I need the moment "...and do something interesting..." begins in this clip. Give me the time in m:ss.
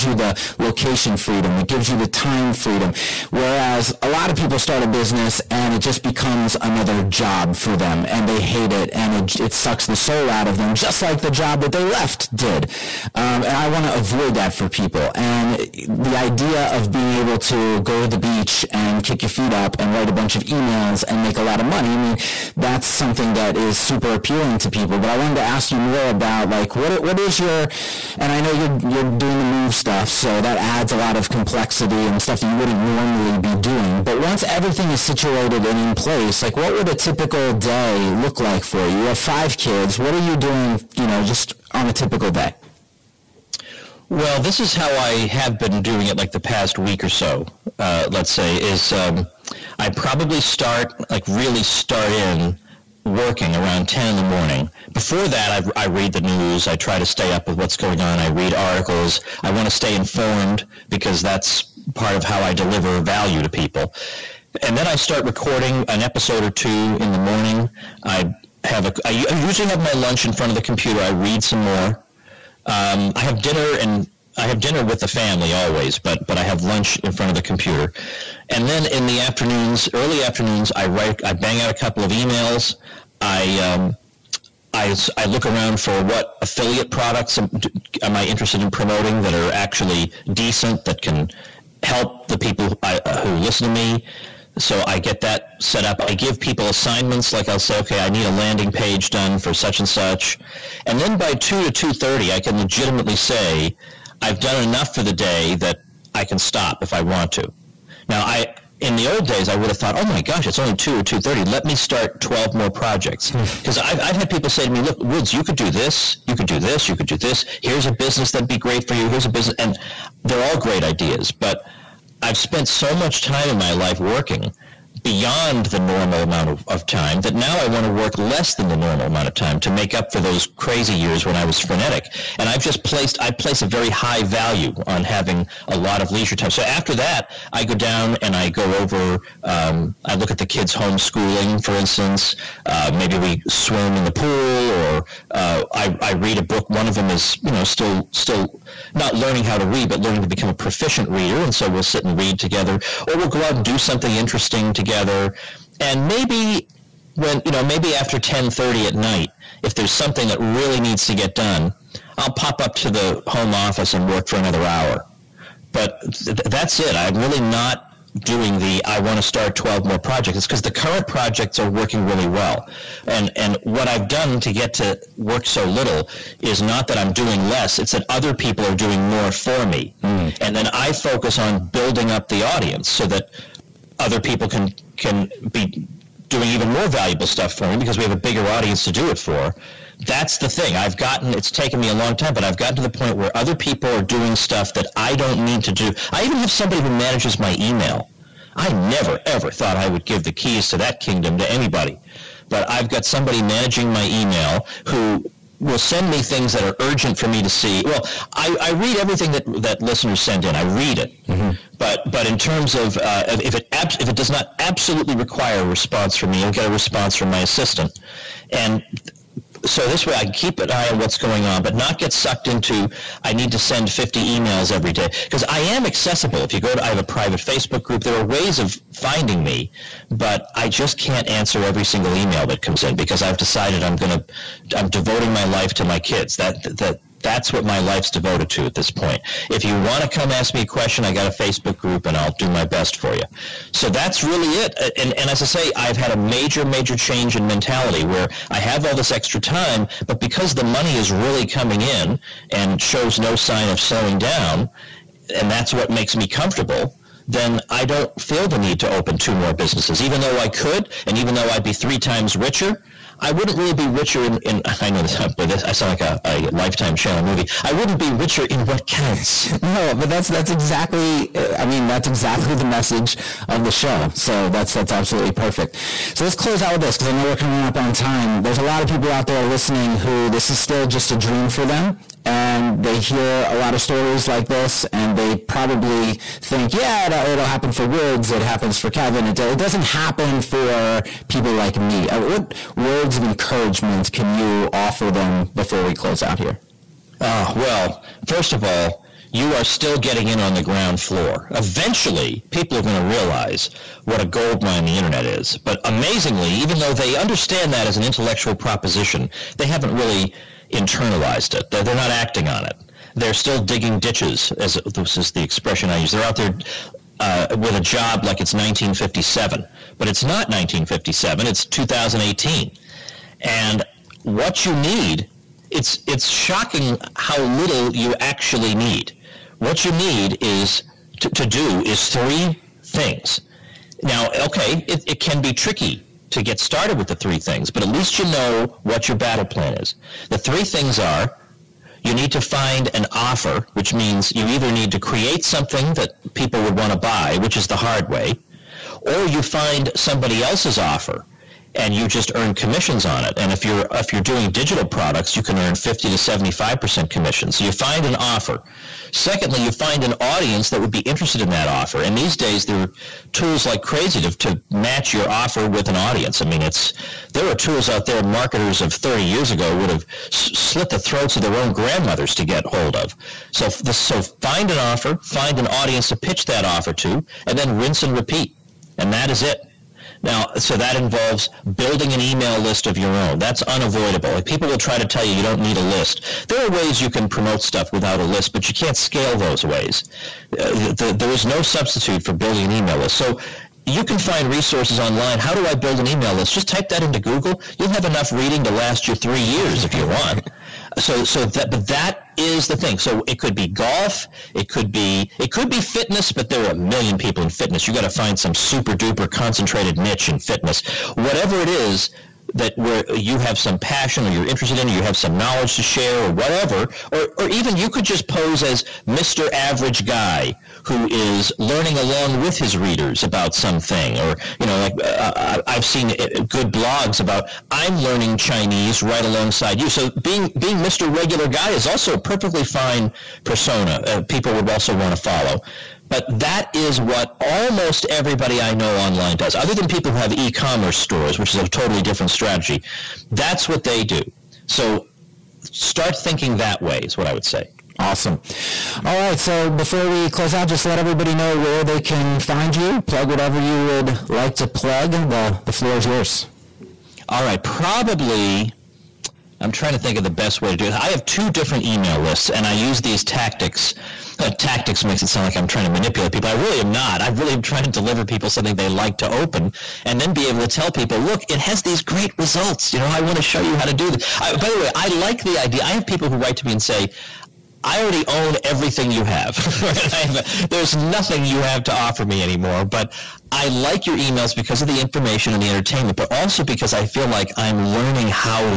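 2:33.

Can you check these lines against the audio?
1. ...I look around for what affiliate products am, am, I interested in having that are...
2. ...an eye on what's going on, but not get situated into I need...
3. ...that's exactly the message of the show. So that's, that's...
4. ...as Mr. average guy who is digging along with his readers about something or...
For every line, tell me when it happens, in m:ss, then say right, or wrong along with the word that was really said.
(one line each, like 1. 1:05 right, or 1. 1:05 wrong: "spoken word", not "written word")
1. 1:25 wrong: "promoting", not "having"
2. 3:40 wrong: "sucked", not "situated"
3. 4:31 right
4. 6:58 wrong: "learning", not "digging".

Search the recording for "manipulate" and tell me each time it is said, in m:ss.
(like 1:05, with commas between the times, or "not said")
7:45.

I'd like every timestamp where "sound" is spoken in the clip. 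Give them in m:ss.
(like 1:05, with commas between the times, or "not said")
4:25, 7:45.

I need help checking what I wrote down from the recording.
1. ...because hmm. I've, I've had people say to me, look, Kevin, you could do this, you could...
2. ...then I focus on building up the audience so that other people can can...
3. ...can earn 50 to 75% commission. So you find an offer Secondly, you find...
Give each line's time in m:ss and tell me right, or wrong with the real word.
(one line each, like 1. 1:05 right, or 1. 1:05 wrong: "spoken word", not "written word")
1. 1:53 wrong: "Woods", not "Kevin"
2. 3:00 right
3. 5:55 right.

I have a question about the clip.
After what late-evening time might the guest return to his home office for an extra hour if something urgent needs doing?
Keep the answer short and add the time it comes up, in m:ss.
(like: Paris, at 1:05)
10:30 at night, at 2:38.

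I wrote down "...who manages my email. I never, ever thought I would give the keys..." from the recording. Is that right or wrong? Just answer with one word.
right.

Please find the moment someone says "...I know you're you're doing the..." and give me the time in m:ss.
0:28.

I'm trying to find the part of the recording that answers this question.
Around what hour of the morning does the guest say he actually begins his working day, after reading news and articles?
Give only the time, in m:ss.
0:53.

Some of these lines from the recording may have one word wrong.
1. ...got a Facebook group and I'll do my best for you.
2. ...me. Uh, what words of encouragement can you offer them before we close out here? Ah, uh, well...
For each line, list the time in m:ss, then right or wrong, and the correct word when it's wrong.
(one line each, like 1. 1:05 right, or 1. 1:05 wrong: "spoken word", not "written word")
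1. 4:01 right
2. 4:51 right.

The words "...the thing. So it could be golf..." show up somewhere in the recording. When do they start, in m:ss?
6:42.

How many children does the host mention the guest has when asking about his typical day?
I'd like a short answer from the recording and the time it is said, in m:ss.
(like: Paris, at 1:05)
5, at 0:39.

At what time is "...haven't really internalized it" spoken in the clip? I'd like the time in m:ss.
5:09.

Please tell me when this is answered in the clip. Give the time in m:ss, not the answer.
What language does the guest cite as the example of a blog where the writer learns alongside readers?
7:08.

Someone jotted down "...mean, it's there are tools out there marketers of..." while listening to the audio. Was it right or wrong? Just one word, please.
right.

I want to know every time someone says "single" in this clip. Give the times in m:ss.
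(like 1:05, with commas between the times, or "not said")
3:51.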